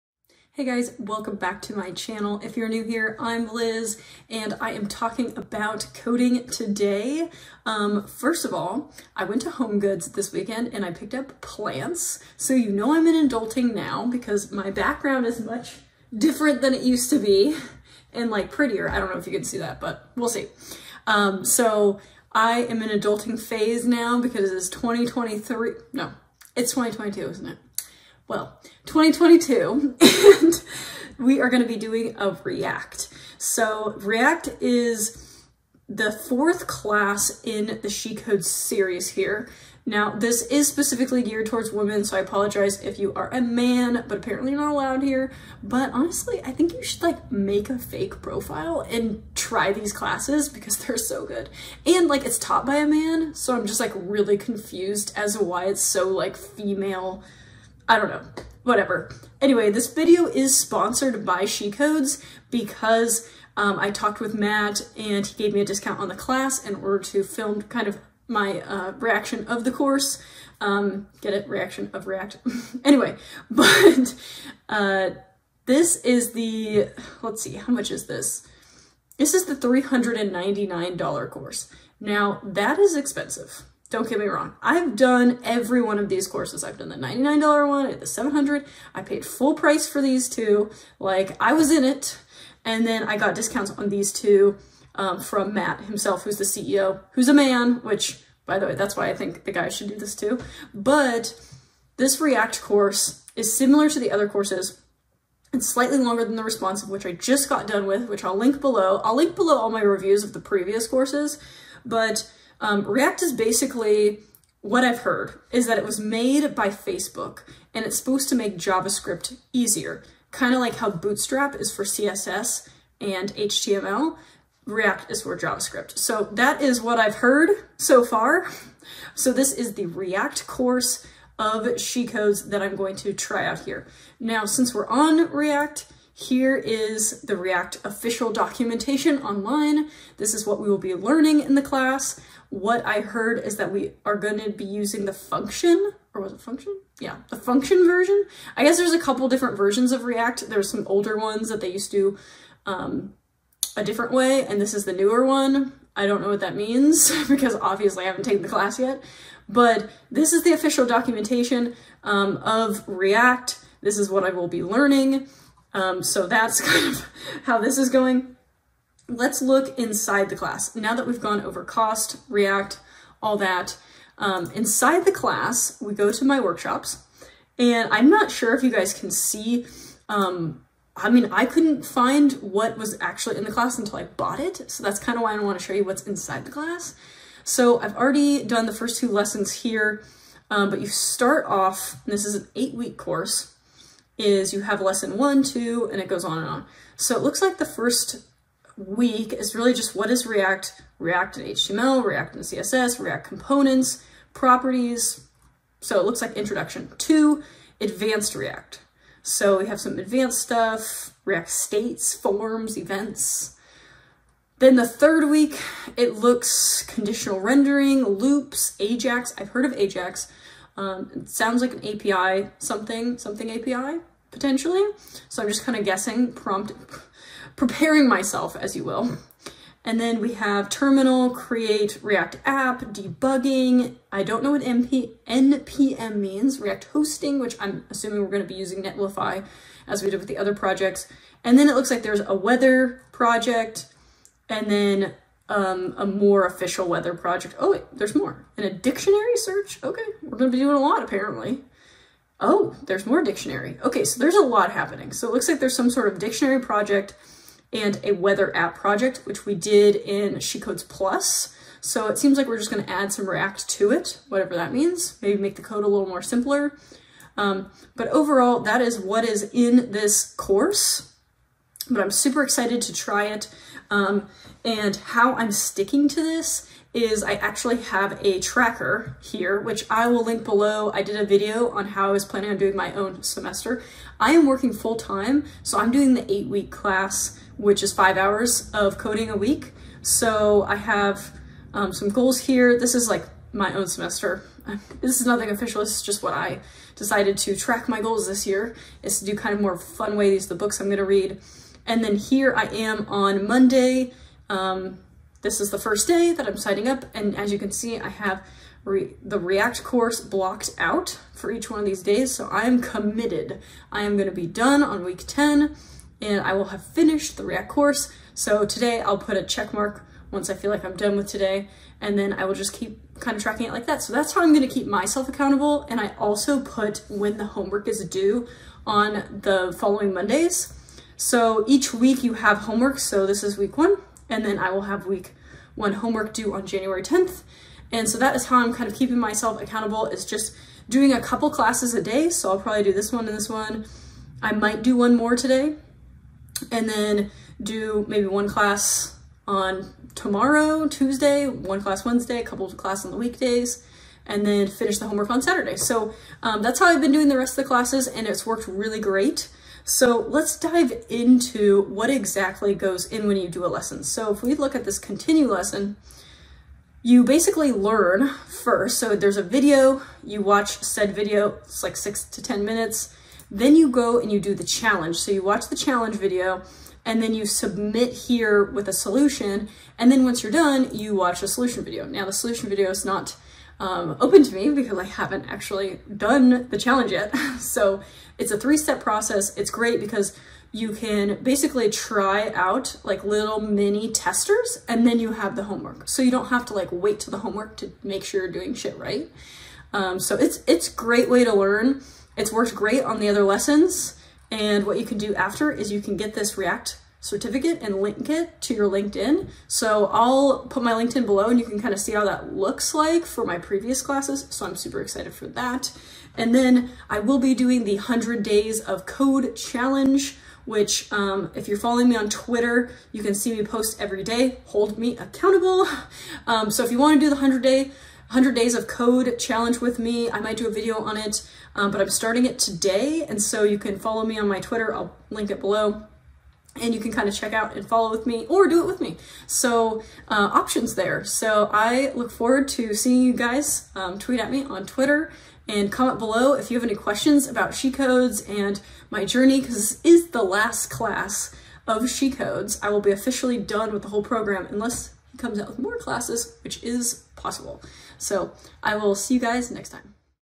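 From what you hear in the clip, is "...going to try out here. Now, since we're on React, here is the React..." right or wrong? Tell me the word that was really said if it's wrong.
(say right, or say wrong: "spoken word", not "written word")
right.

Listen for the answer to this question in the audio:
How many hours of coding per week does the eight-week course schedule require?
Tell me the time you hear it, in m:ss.
4:47.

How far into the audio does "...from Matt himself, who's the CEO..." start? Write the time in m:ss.
1:35.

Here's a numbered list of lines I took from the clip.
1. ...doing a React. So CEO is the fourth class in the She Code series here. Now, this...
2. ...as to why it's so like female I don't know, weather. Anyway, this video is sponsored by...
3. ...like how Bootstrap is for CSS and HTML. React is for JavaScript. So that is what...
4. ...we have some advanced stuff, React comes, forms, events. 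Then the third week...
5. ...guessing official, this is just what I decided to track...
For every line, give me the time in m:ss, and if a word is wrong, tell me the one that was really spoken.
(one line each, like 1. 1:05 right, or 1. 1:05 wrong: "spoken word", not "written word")
1. 0:31 wrong: "React", not "CEO"
2. 0:55 wrong: "whatever", not "weather"
3. 2:00 right
4. 3:29 wrong: "states", not "comes"
5. 4:55 wrong: "nothing", not "guessing".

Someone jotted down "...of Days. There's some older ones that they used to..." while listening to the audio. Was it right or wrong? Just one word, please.
wrong.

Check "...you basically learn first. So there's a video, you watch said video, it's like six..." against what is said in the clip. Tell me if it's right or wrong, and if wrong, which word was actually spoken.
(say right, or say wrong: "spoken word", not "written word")
right.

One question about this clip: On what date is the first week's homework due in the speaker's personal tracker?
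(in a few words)
January 10th.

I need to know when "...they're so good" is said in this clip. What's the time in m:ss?
0:50.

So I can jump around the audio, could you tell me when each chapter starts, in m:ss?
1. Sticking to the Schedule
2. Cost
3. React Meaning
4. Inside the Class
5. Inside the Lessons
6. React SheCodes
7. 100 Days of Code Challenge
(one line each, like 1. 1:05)
1. 4:36
2. 1:18
3. 1:42
4. 2:56
5. 6:04
6. 0:34
7. 6:58.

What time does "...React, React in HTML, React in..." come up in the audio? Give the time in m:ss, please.
3:20.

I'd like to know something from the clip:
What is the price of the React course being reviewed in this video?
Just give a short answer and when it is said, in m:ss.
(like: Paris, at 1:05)
$399, at 1:19.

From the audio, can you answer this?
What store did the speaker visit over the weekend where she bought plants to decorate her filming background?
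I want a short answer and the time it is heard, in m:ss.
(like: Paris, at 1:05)
Home Goods, at 0:09.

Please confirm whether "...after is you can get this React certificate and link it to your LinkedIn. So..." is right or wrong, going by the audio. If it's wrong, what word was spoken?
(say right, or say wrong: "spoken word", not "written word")
right.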